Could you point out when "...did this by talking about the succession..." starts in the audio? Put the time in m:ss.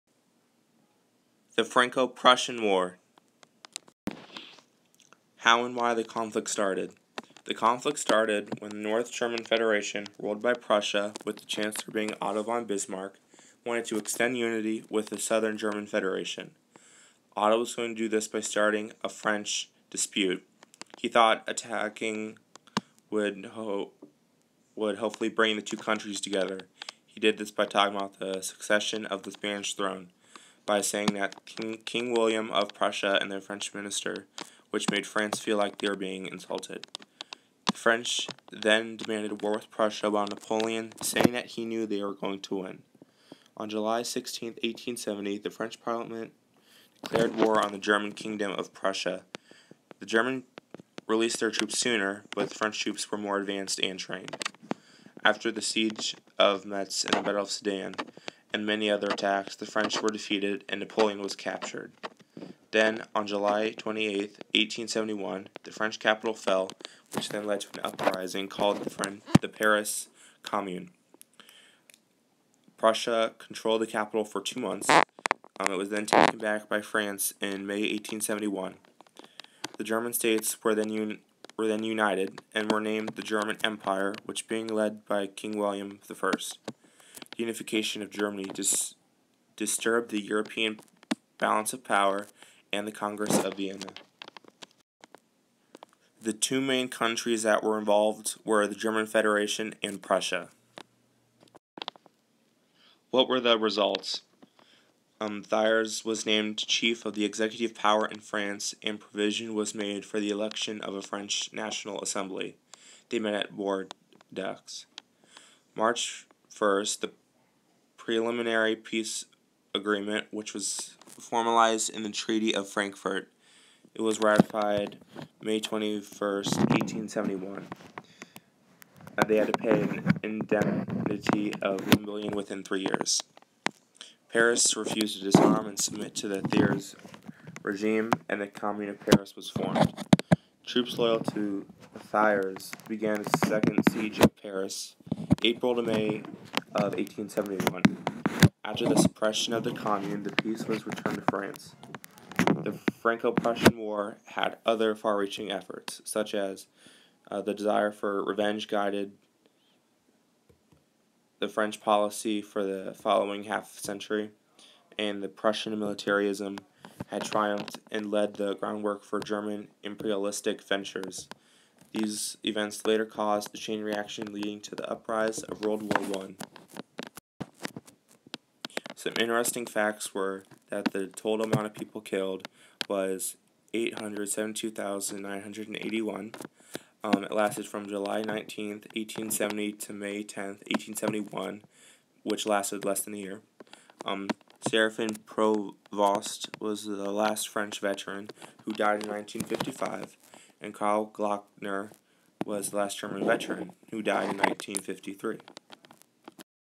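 0:27.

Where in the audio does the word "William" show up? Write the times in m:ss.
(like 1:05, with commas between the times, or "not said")
0:32, 1:25.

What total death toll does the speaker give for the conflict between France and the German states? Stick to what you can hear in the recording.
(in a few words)
872,981.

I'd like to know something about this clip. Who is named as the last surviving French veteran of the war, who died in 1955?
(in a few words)
Seraphin Provost.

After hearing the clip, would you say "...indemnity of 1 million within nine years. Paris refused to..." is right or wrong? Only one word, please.
wrong.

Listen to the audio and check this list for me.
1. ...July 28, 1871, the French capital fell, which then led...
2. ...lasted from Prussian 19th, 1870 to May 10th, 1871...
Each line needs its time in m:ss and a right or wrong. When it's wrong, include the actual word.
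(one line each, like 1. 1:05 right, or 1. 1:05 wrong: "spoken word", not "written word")
1. 1:03 right
2. 3:07 wrong: "July", not "Prussian".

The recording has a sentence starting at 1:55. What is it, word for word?
March 1st, the preliminary peace agreement, which was formalized in the Treaty of Frankfurt.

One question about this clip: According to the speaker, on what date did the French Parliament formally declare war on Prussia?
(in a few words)
July 16, 1870.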